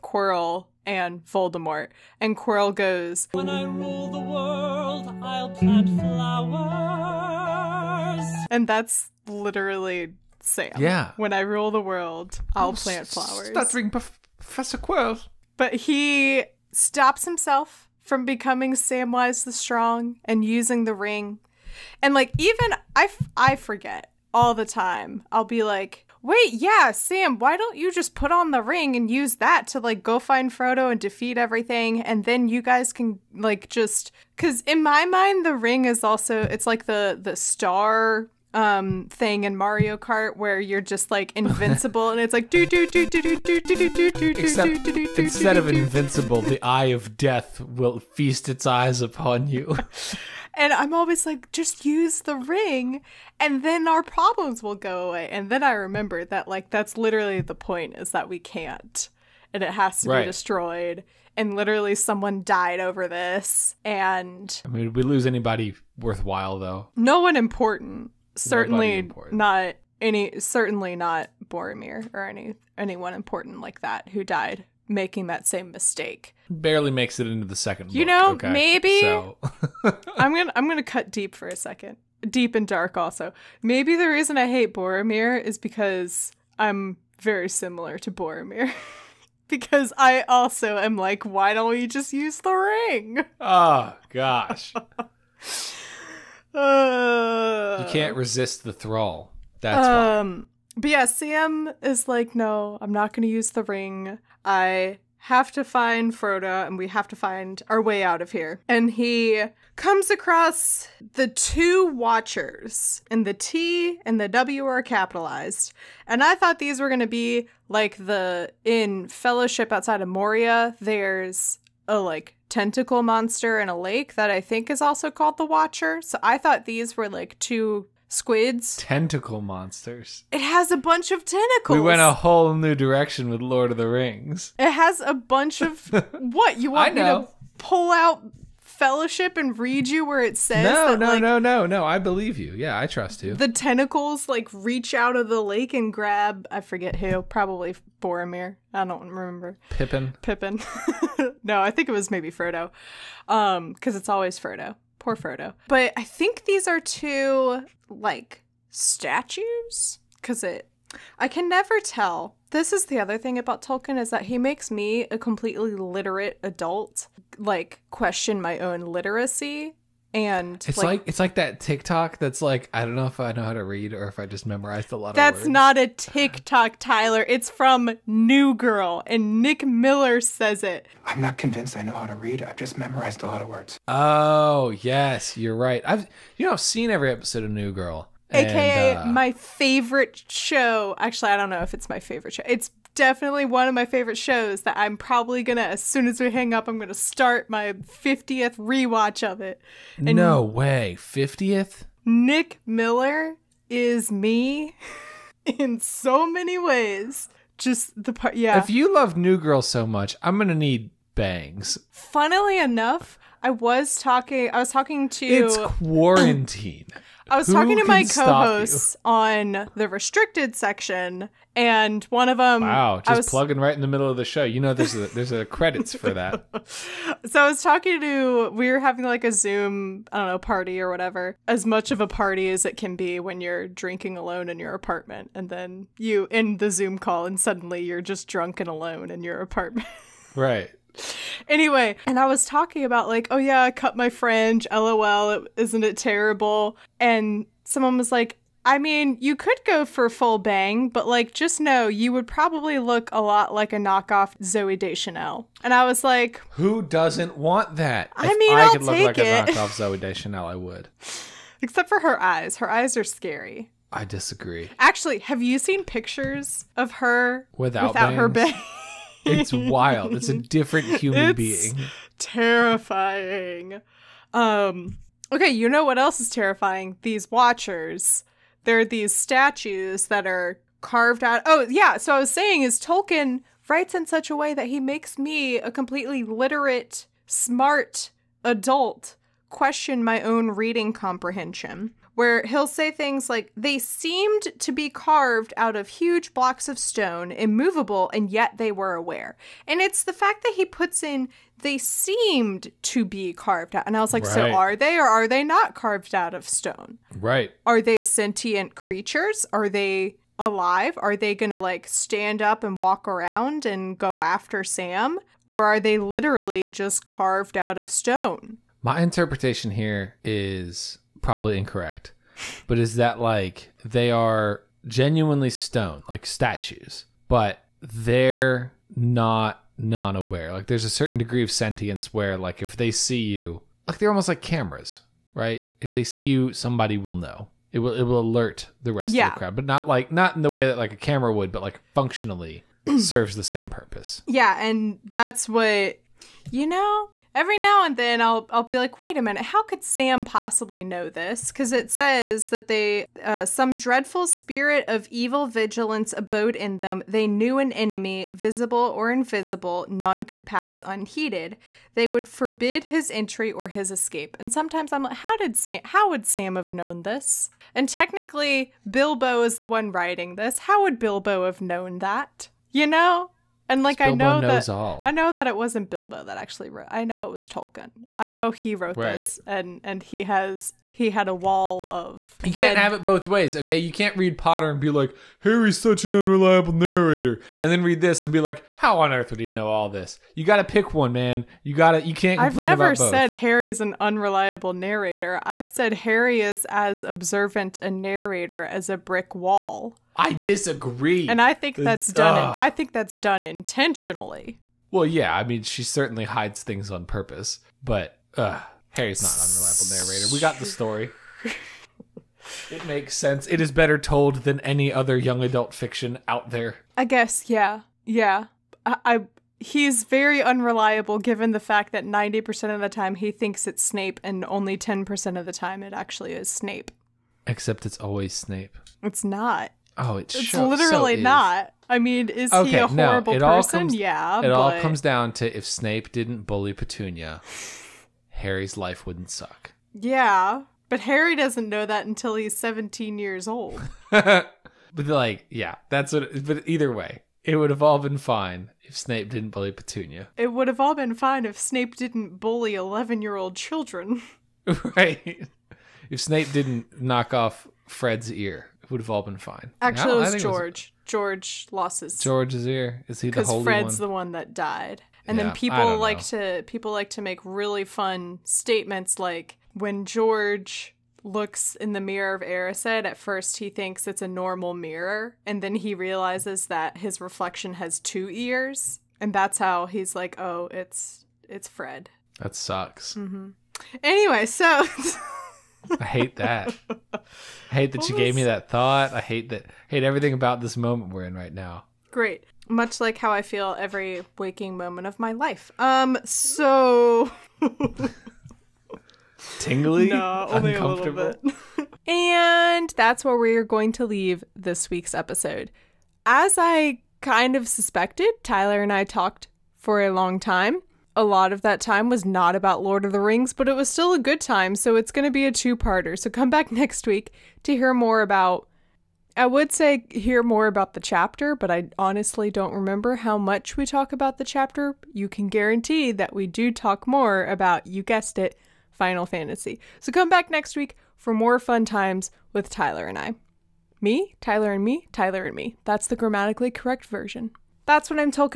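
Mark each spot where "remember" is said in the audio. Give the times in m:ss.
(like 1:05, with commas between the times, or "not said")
0:55, 2:29, 8:42.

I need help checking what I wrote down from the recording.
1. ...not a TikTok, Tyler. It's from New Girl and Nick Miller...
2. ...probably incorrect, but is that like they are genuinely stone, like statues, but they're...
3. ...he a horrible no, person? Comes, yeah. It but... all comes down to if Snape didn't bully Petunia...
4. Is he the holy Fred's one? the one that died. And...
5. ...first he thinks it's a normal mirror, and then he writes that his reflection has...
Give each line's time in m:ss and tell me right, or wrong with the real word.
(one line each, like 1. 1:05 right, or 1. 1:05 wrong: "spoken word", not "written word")
1. 2:55 right
2. 5:21 right
3. 7:12 right
4. 7:43 right
5. 7:53 wrong: "realizes", not "writes".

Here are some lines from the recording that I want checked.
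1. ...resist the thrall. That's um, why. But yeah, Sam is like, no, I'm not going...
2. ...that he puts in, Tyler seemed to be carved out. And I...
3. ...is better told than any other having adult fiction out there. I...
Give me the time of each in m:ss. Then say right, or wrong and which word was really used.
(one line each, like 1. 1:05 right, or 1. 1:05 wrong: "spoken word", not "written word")
1. 1:38 right
2. 5:00 wrong: "They", not "Tyler"
3. 6:53 wrong: "young", not "having".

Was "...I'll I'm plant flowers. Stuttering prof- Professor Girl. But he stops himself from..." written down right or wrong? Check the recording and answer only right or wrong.
wrong.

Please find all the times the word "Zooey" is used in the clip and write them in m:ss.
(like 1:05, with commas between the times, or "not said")
4:14, 4:19.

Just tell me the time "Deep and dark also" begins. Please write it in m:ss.
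1:22.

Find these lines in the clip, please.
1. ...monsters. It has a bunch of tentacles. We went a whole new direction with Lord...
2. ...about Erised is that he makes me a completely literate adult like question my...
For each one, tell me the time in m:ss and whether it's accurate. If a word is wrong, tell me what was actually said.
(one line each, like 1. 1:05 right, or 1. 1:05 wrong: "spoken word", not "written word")
1. 2:09 right
2. 2:43 wrong: "Tolkien", not "Erised".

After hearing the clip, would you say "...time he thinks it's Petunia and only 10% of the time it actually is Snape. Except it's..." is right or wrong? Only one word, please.
wrong.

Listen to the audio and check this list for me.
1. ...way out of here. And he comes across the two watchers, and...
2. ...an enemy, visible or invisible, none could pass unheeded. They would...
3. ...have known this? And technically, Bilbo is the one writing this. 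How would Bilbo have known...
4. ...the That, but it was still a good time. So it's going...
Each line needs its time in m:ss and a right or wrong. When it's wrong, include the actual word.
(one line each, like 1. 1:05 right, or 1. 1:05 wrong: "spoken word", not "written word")
1. 1:47 right
2. 5:57 right
3. 6:06 right
4. 8:33 wrong: "Rings", not "That".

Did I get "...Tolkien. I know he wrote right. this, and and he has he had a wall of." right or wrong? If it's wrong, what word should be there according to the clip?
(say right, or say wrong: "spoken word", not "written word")
right.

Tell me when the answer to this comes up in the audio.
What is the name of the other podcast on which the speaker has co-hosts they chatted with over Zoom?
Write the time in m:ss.
3:39.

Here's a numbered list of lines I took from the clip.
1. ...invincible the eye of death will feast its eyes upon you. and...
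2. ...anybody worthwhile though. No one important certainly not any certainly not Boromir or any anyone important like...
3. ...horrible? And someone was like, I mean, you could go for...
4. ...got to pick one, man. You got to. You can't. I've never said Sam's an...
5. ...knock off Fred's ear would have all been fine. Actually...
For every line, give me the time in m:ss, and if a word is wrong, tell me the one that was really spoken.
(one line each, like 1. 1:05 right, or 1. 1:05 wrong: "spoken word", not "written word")
1. 0:45 right
2. 1:05 right
3. 4:05 wrong: "terrible", not "horrible"
4. 6:30 wrong: "Harry", not "Sam"
5. 7:37 right.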